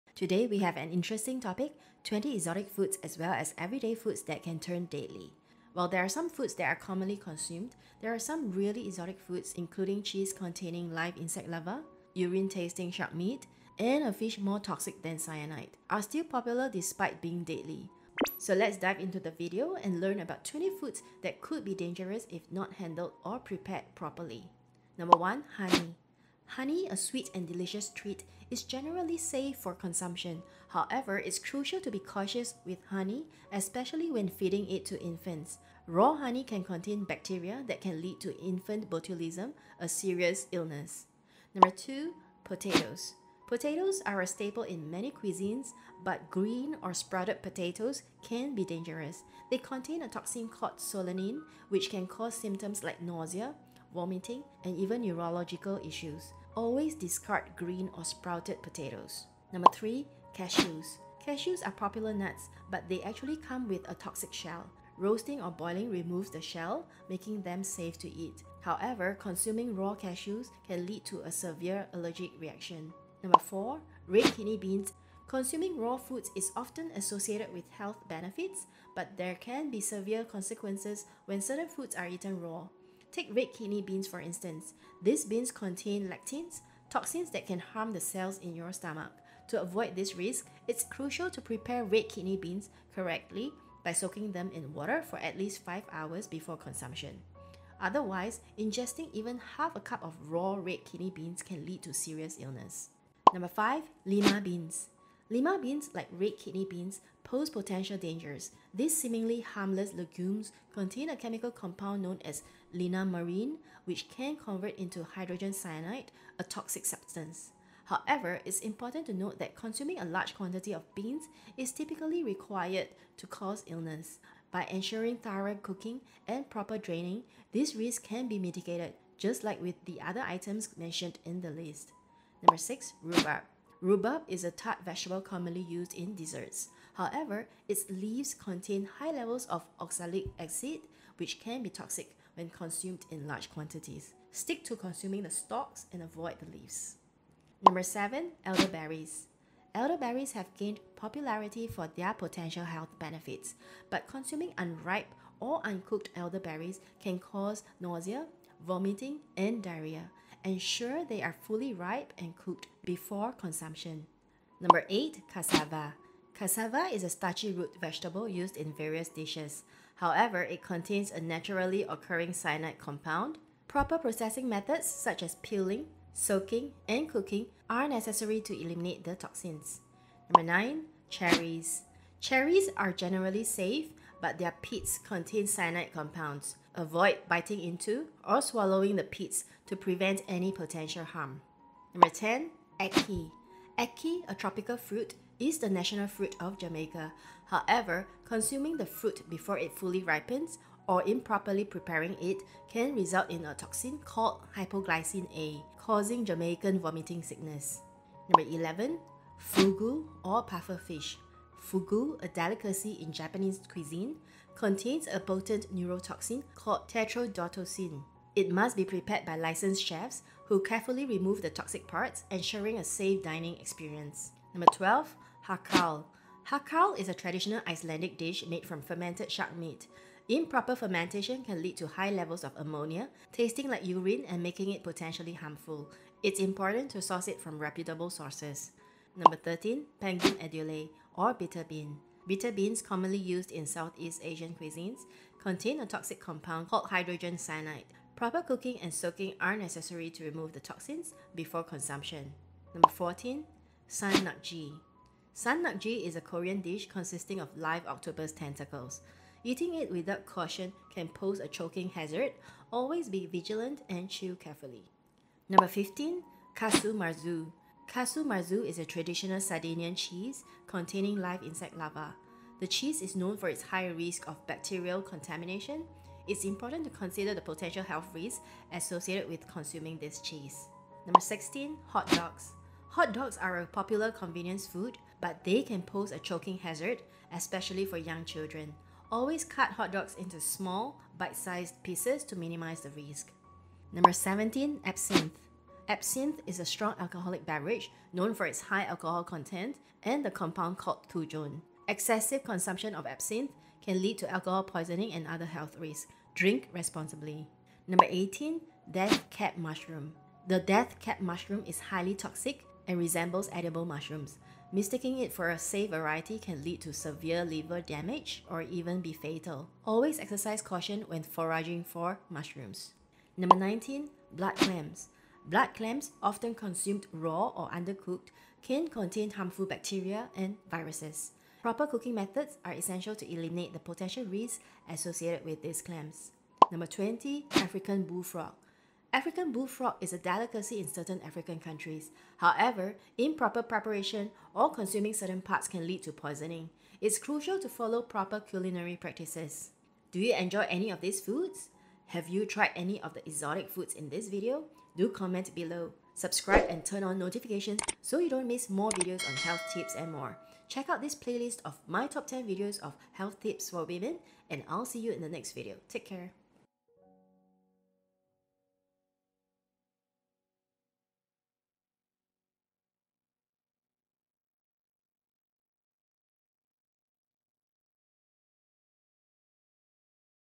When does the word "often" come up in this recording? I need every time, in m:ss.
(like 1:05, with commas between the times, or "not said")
1:16, 5:26.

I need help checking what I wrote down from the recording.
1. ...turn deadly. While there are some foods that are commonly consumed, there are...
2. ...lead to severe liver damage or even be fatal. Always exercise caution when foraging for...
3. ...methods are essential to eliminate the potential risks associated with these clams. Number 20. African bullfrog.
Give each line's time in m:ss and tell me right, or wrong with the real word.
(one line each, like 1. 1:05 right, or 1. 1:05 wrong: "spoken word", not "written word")
1. 0:04 right
2. 5:16 right
3. 5:32 right.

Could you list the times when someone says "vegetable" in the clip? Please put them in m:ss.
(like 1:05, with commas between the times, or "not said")
2:14, 2:47.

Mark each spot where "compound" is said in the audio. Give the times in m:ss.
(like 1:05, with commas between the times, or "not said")
1:51, 2:52, 3:05, 4:06, 5:00.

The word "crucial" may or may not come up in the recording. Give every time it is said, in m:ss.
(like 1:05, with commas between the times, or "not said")
0:31, 1:30, 5:47.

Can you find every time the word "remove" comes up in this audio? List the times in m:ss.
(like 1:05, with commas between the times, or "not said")
1:05, 3:41, 4:10.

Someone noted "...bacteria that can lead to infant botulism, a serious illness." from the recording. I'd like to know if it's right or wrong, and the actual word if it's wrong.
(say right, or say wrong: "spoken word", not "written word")
right.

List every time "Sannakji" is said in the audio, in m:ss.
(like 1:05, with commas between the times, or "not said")
4:15.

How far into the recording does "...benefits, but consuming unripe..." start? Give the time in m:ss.
2:32.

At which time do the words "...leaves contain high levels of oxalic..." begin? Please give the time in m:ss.
2:17.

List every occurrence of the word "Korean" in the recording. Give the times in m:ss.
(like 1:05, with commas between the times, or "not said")
4:16.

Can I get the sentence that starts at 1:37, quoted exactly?
Otherwise, ingesting even half a cup of raw red kidney beans can lead to serious illness.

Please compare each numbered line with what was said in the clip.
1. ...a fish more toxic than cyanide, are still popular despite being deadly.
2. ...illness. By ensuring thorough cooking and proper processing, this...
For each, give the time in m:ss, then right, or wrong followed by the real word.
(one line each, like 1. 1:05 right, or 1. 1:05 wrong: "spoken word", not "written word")
1. 0:14 right
2. 2:03 wrong: "draining", not "processing".